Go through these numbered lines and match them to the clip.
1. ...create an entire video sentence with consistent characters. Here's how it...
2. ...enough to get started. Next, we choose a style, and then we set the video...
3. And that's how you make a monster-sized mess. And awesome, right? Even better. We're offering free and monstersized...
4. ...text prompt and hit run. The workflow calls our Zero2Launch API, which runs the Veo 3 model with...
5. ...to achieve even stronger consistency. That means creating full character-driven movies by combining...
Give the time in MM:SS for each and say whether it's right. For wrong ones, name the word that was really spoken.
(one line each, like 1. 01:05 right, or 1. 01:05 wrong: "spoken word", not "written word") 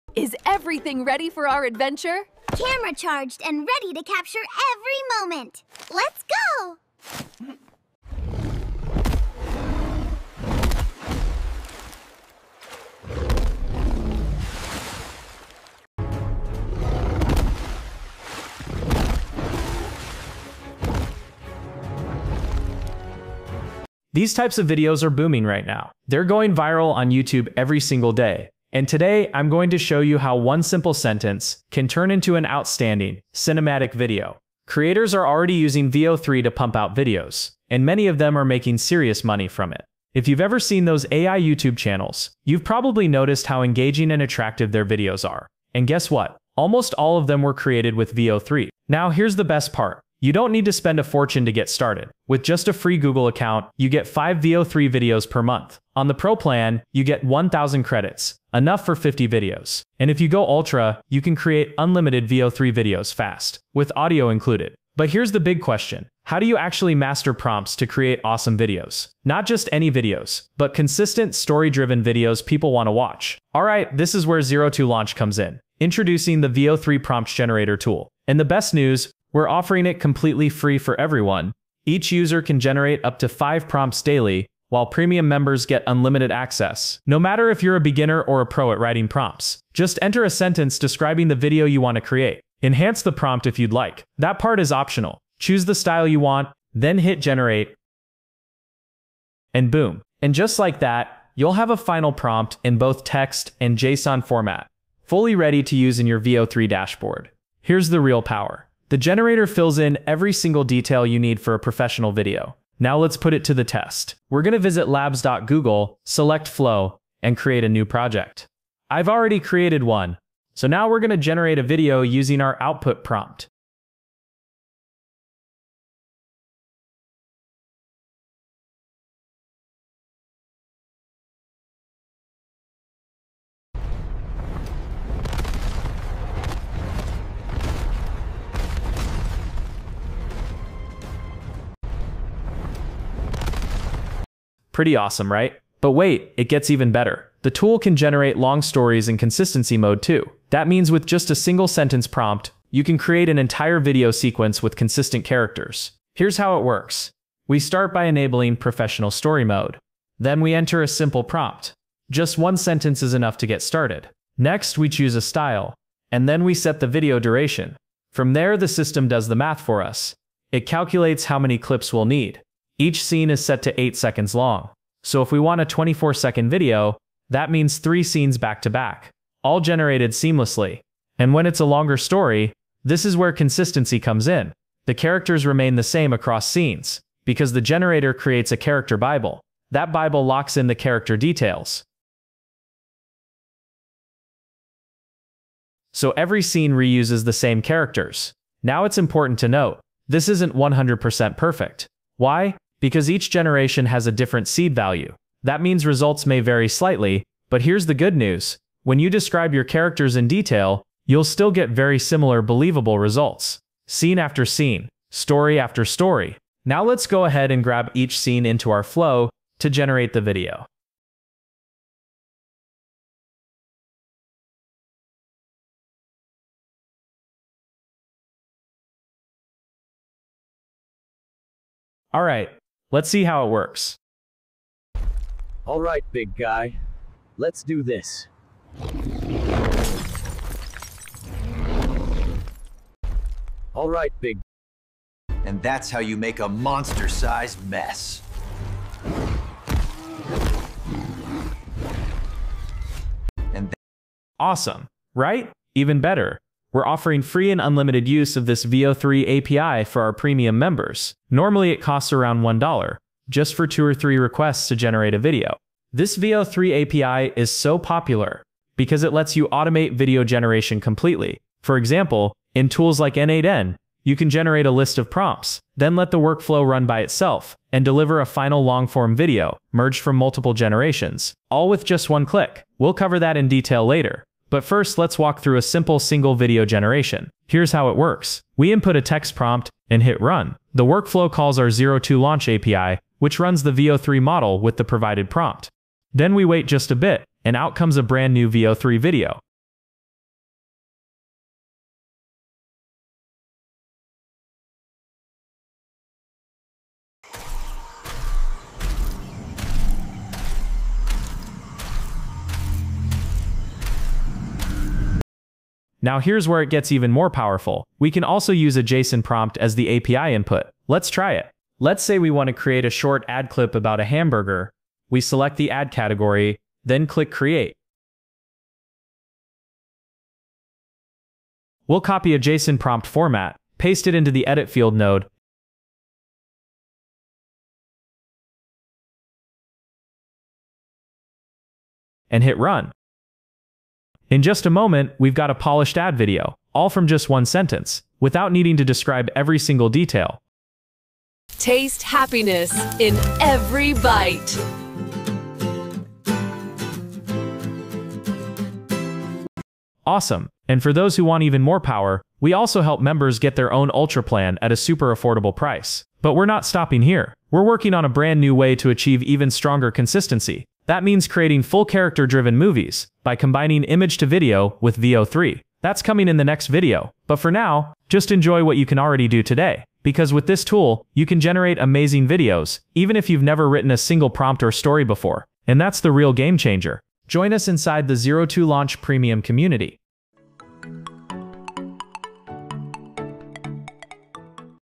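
1. 02:32 wrong: "sequence", not "sentence"
2. 02:43 right
3. 04:05 wrong: "unlimited", not "monstersized"
4. 04:49 right
5. 06:08 right.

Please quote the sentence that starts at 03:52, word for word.
All right, Let's see how it works.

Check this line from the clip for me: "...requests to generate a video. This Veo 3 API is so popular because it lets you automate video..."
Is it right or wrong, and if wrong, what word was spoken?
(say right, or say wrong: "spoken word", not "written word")
right.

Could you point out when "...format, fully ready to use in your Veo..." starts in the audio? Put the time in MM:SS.
01:44.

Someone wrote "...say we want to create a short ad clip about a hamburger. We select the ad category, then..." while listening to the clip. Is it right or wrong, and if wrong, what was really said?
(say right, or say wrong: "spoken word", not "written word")
right.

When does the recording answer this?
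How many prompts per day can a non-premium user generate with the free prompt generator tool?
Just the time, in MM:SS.
01:23.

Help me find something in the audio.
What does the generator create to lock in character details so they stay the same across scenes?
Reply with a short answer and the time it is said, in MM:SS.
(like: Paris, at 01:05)
A character bible, at 03:08.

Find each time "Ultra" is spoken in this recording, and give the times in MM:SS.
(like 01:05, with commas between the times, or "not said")
01:00, 06:03.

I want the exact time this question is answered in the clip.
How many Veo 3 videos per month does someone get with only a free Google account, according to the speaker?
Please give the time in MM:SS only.
00:54.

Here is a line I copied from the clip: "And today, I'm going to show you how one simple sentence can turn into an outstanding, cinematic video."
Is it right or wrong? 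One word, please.
right.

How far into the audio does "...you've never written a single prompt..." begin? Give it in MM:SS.
06:23.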